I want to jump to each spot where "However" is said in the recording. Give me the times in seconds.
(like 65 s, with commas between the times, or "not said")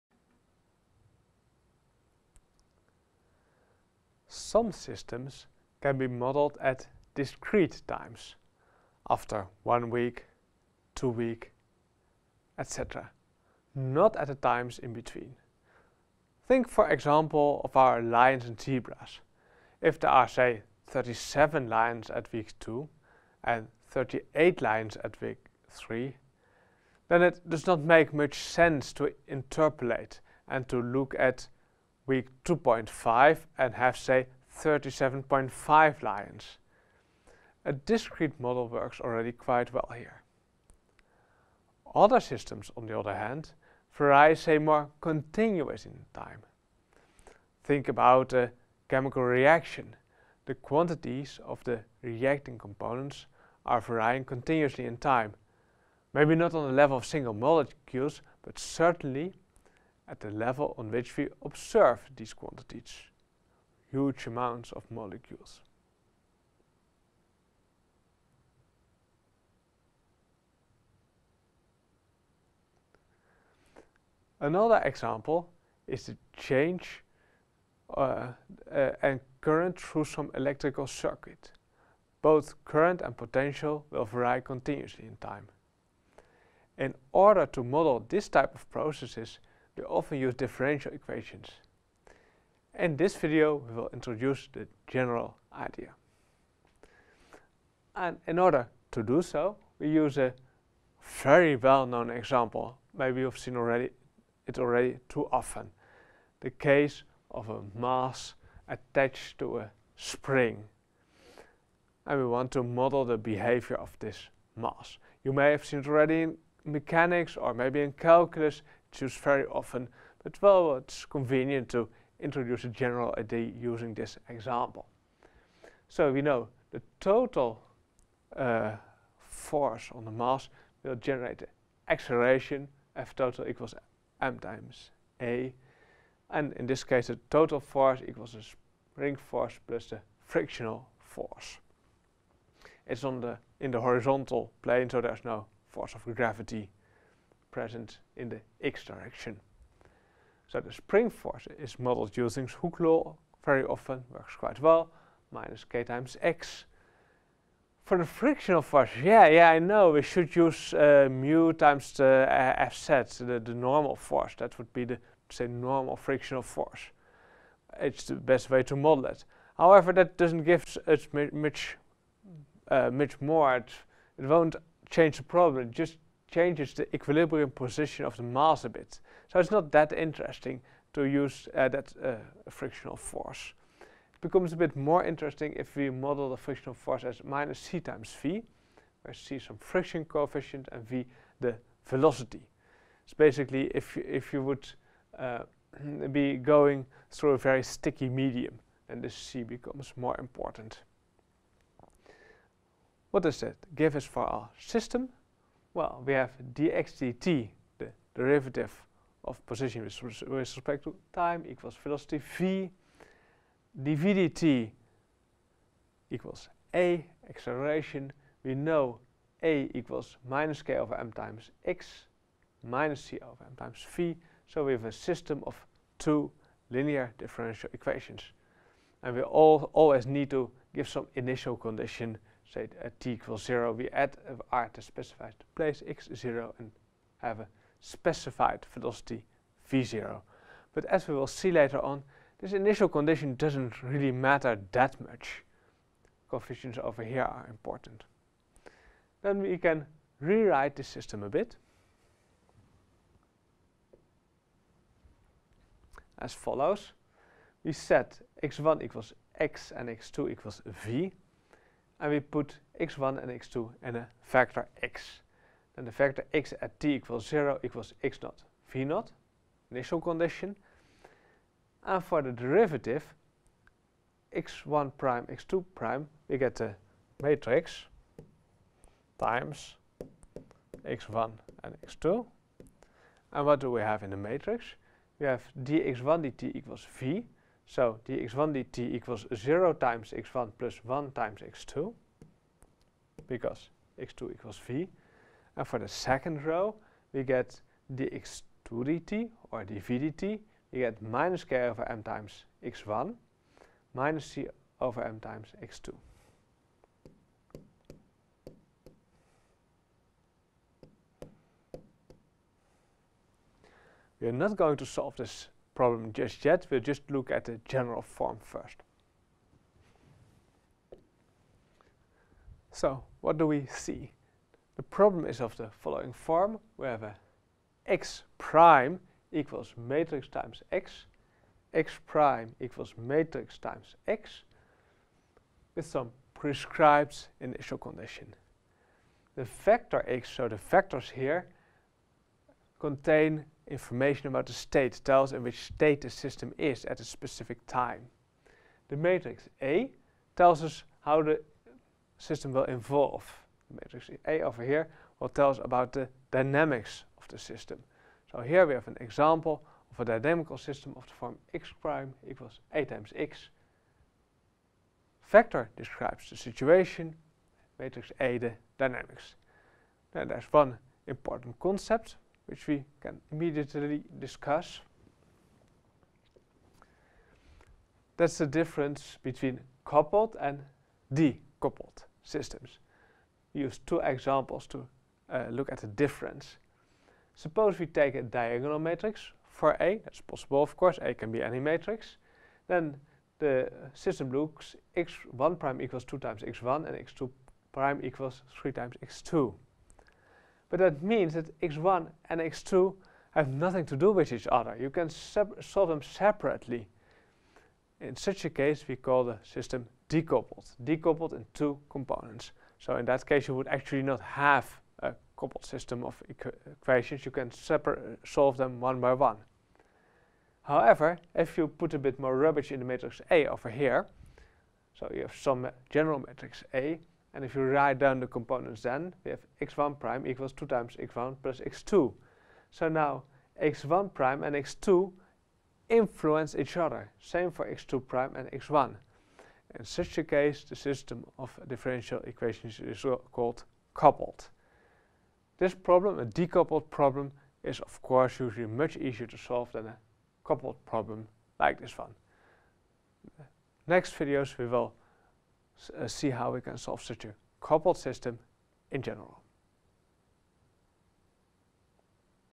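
169 s, 420 s.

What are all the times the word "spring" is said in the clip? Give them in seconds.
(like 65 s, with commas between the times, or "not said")
109 s, 138 s, 150 s.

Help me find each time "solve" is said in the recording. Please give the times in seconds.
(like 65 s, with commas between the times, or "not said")
314 s, 405 s, 418 s, 449 s.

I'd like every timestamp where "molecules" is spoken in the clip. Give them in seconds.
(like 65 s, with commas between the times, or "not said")
57 s, 64 s.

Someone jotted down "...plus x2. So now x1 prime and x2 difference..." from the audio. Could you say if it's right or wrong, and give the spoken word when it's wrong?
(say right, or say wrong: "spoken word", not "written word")
wrong: "influence", not "difference".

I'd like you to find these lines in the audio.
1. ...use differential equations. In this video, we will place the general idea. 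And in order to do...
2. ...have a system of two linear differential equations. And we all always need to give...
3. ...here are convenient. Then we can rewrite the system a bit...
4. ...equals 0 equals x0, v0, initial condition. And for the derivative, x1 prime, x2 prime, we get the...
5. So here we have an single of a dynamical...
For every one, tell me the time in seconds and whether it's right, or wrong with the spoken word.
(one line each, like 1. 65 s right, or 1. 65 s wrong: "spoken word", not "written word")
1. 90 s wrong: "introduce", not "place"
2. 224 s right
3. 247 s wrong: "important", not "convenient"
4. 266 s right
5. 358 s wrong: "example", not "single".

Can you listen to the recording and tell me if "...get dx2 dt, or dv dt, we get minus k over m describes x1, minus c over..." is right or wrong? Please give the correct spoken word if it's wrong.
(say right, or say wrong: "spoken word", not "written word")
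wrong: "times", not "describes".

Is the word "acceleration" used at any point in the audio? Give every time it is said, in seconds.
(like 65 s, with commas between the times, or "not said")
131 s, 217 s.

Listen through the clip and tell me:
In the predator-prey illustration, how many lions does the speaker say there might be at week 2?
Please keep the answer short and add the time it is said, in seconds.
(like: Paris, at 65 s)
37, at 20 s.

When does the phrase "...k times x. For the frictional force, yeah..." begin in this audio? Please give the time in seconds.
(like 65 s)
155 s.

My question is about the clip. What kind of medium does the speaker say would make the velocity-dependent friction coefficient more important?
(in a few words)
a very sticky medium.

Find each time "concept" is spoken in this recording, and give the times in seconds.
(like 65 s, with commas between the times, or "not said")
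371 s.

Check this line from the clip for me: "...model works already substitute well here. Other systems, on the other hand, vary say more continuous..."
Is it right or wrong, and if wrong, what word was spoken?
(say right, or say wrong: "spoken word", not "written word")
wrong: "quite", not "substitute".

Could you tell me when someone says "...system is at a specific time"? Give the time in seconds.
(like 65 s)
346 s.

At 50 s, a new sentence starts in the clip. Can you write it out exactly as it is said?
The quantities of the reacting components are varying continuously in time.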